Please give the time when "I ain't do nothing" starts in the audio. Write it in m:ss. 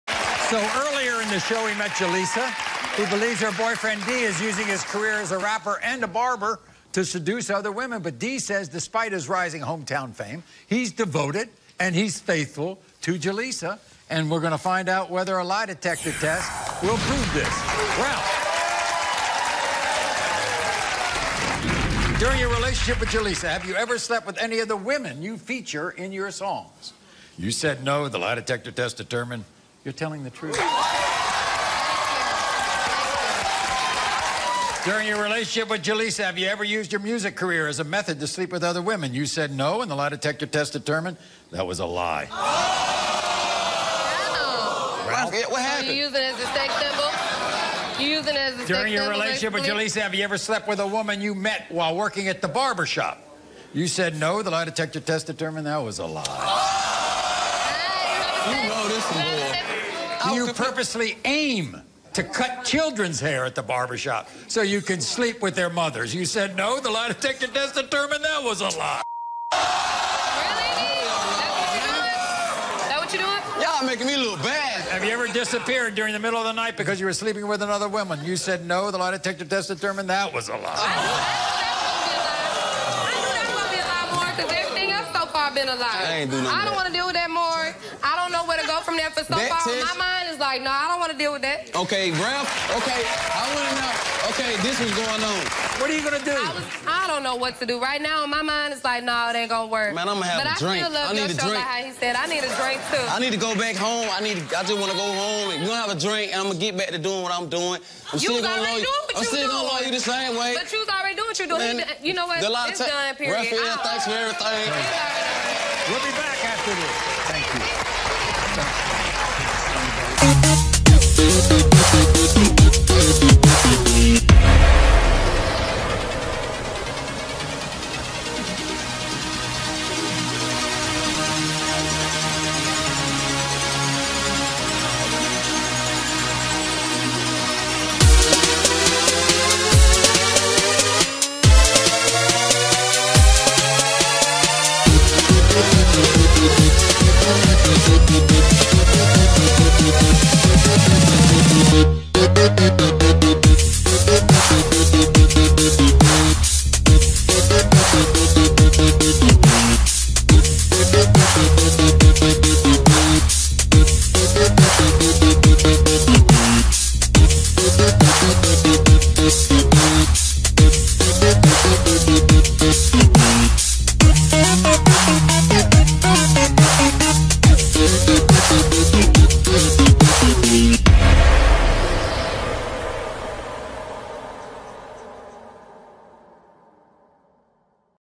1:26.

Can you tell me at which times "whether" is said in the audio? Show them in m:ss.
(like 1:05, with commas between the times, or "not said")
0:15.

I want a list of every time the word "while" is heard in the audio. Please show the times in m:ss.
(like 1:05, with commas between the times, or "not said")
0:51.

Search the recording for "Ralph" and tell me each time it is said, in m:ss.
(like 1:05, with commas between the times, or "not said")
0:17, 1:32.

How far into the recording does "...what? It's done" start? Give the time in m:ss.
1:52.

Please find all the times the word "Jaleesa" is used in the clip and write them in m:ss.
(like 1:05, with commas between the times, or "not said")
0:01, 0:13, 0:23, 0:35, 0:49.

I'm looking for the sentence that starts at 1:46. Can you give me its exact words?
and I'm gonna get back to doing what I'm doing.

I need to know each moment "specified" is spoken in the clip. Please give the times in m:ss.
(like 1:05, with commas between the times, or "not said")
not said.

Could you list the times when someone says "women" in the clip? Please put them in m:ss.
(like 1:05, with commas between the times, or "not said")
0:07, 0:24, 0:38.